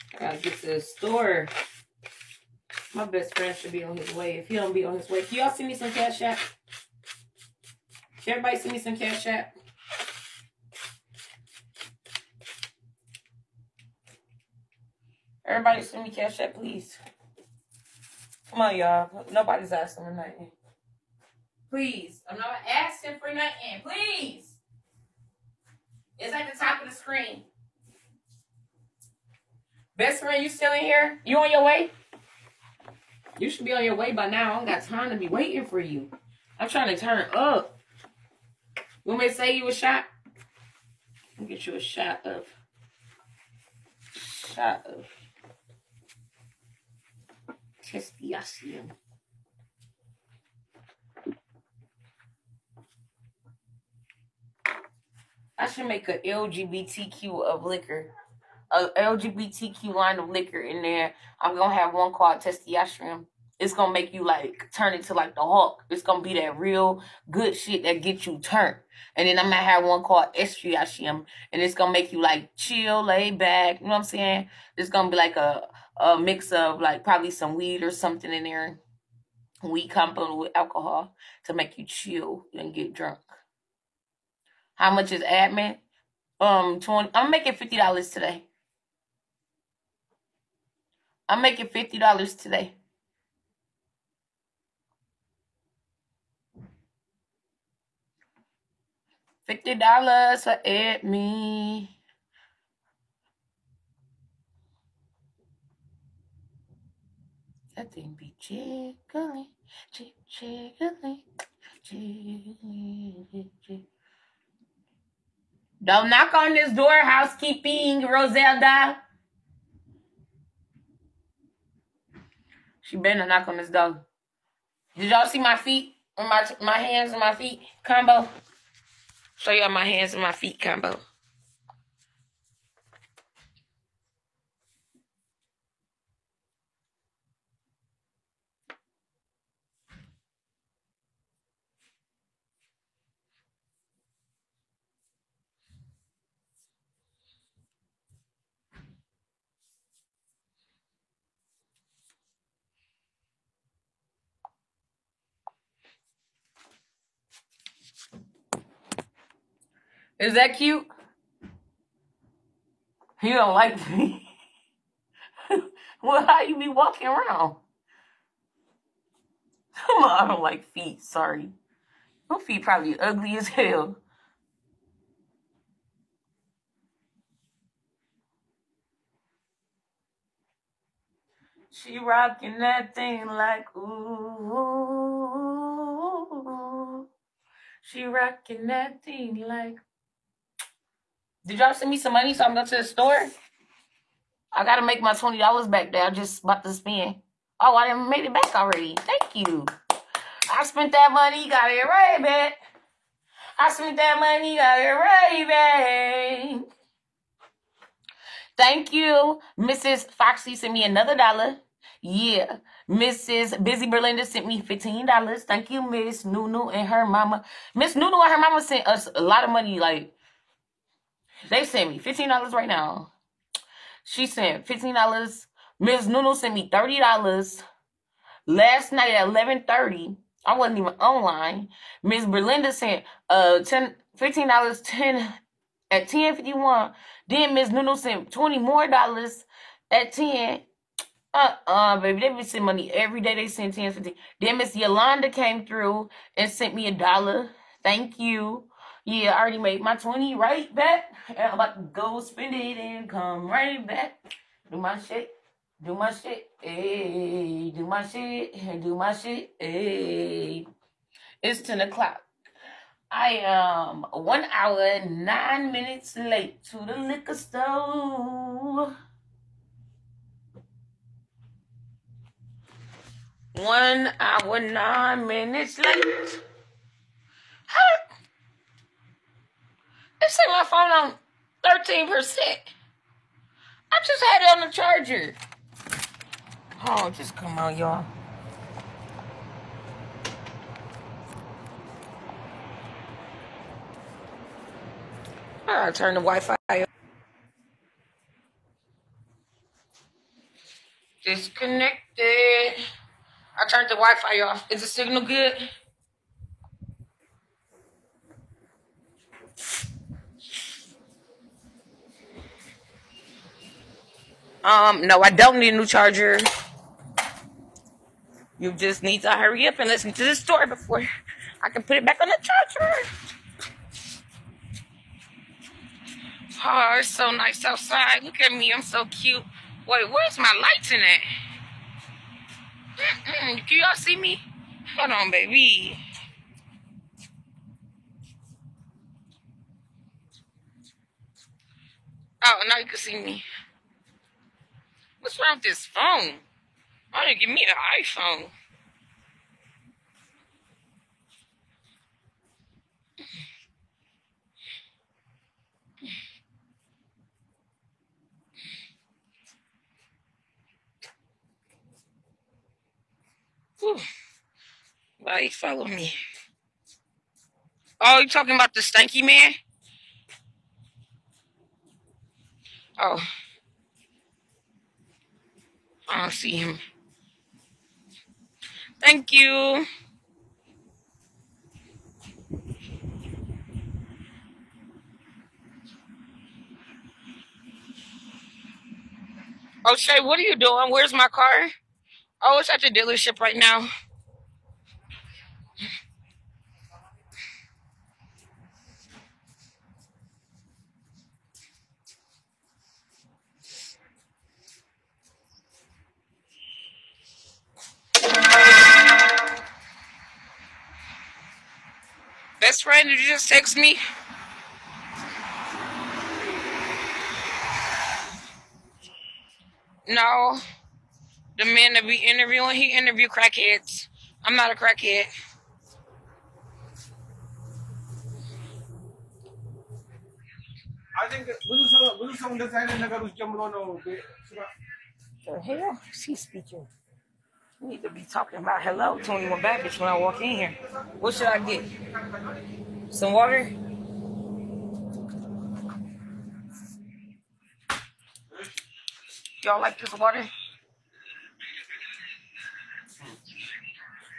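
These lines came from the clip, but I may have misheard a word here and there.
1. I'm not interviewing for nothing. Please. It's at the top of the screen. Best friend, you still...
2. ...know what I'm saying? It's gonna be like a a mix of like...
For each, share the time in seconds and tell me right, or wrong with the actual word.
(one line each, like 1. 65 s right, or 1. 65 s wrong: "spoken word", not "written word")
1. 22 s wrong: "asking", not "interviewing"
2. 73 s right.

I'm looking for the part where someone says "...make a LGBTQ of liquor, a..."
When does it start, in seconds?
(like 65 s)
55 s.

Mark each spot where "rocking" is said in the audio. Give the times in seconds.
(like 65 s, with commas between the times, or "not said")
181 s, 188 s.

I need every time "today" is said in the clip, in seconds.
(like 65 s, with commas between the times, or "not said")
88 s, 92 s.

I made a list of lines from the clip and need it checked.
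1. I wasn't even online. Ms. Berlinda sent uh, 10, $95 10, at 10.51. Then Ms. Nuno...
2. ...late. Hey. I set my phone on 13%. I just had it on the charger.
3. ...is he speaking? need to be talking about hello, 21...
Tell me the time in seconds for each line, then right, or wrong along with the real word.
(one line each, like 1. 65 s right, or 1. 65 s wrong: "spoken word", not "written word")
1. 230 s wrong: "15", not "95"
2. 275 s right
3. 436 s right.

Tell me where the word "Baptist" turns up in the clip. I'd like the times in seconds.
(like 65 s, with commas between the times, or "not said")
439 s.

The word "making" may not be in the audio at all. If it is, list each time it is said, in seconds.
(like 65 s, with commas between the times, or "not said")
87 s, 91 s.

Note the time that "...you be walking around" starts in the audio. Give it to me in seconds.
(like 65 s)
166 s.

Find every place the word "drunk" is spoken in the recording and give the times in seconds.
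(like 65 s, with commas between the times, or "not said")
82 s.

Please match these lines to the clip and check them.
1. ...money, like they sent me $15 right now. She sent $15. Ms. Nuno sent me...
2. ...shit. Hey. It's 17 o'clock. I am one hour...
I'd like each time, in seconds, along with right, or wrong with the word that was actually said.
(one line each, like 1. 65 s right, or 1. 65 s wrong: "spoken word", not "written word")
1. 219 s right
2. 259 s wrong: "10", not "17".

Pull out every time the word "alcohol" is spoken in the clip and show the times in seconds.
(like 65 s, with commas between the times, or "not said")
80 s.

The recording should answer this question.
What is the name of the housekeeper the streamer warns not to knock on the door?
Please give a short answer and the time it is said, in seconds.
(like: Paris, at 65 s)
Roselda, at 118 s.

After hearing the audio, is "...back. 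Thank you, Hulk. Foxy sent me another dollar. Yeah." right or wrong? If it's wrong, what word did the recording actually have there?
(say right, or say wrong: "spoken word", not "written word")
wrong: "Mrs", not "Hulk".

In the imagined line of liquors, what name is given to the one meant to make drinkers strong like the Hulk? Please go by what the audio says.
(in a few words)
Testosterone.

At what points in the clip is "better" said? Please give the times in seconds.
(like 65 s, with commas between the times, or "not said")
122 s.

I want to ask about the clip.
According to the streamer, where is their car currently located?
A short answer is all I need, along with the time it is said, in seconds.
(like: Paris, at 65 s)
The dealership, at 392 s.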